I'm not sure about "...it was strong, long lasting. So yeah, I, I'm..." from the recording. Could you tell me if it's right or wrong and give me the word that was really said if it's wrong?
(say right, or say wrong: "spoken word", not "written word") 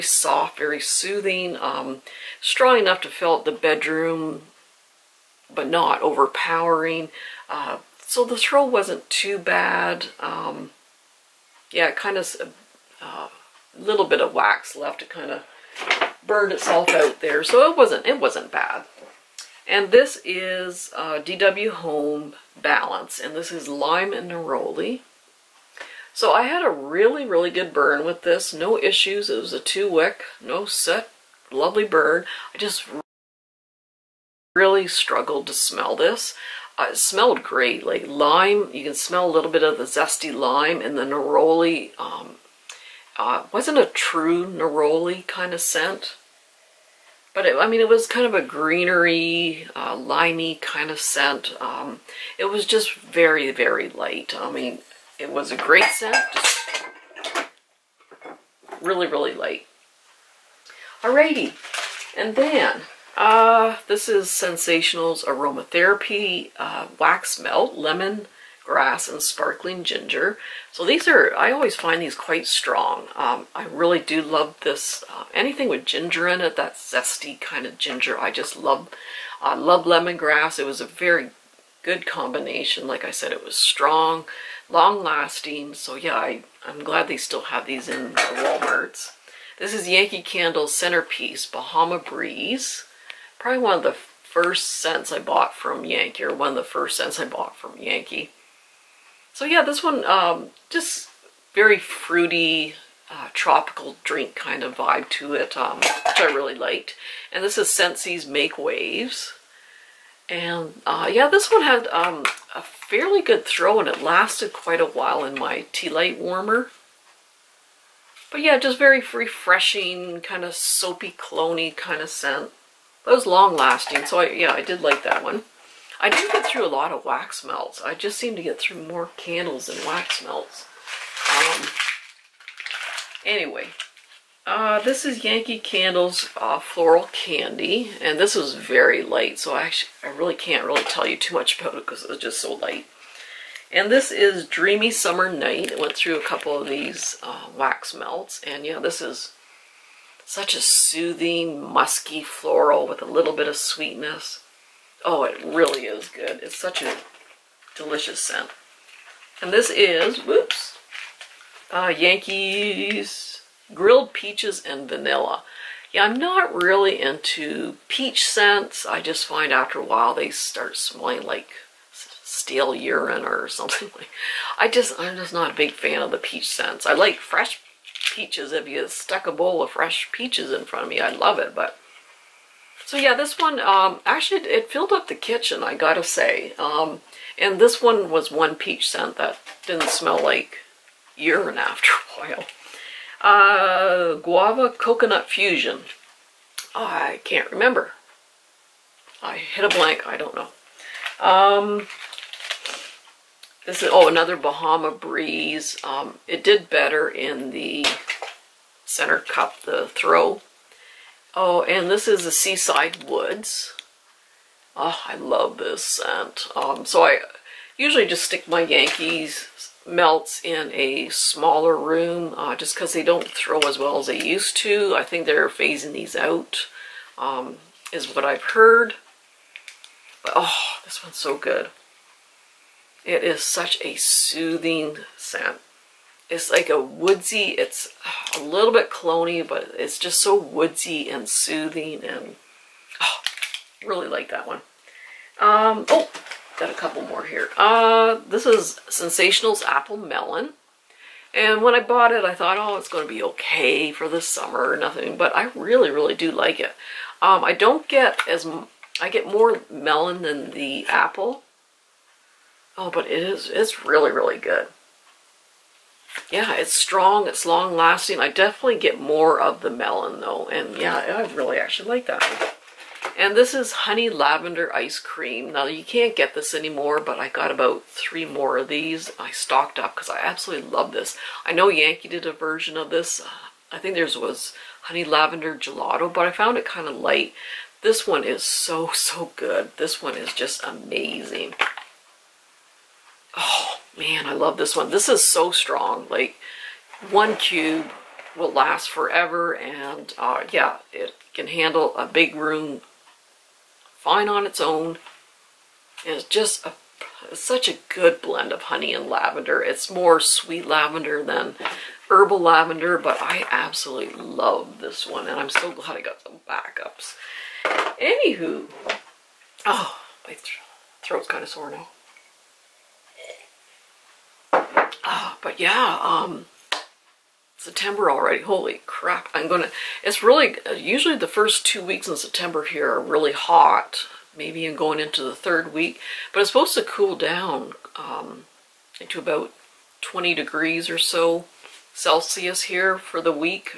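right.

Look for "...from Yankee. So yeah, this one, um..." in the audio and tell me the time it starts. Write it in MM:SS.
01:37.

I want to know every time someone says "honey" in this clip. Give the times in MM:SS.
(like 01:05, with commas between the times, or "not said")
04:33, 04:44, 05:08.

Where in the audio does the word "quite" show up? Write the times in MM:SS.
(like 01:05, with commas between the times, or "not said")
01:12, 01:54.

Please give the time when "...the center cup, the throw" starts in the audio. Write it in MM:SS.
03:27.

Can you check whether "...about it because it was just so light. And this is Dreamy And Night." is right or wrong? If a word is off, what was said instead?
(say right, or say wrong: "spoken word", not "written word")
wrong: "Summer", not "And".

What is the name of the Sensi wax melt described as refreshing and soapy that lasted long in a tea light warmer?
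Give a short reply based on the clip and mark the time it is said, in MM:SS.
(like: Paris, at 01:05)
Make Waves, at 01:48.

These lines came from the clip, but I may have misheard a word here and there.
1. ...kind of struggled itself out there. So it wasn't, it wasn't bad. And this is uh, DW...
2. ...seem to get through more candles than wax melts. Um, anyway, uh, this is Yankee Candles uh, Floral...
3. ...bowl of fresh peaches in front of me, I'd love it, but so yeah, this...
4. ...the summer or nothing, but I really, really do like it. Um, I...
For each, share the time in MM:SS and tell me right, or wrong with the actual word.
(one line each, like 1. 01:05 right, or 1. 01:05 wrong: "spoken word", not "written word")
1. 00:15 wrong: "burned", not "struggled"
2. 02:08 right
3. 02:59 right
4. 04:14 right.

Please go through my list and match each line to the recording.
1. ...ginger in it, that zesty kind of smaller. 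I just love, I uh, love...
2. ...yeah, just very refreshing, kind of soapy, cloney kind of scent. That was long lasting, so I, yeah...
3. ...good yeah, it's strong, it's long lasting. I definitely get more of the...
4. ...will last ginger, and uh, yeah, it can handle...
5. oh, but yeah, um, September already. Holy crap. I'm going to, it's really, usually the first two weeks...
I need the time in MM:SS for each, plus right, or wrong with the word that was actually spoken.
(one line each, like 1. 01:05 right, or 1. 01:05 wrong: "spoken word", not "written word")
1. 01:15 wrong: "ginger", not "smaller"
2. 01:58 right
3. 04:24 right
4. 04:58 wrong: "forever", not "ginger"
5. 05:25 right.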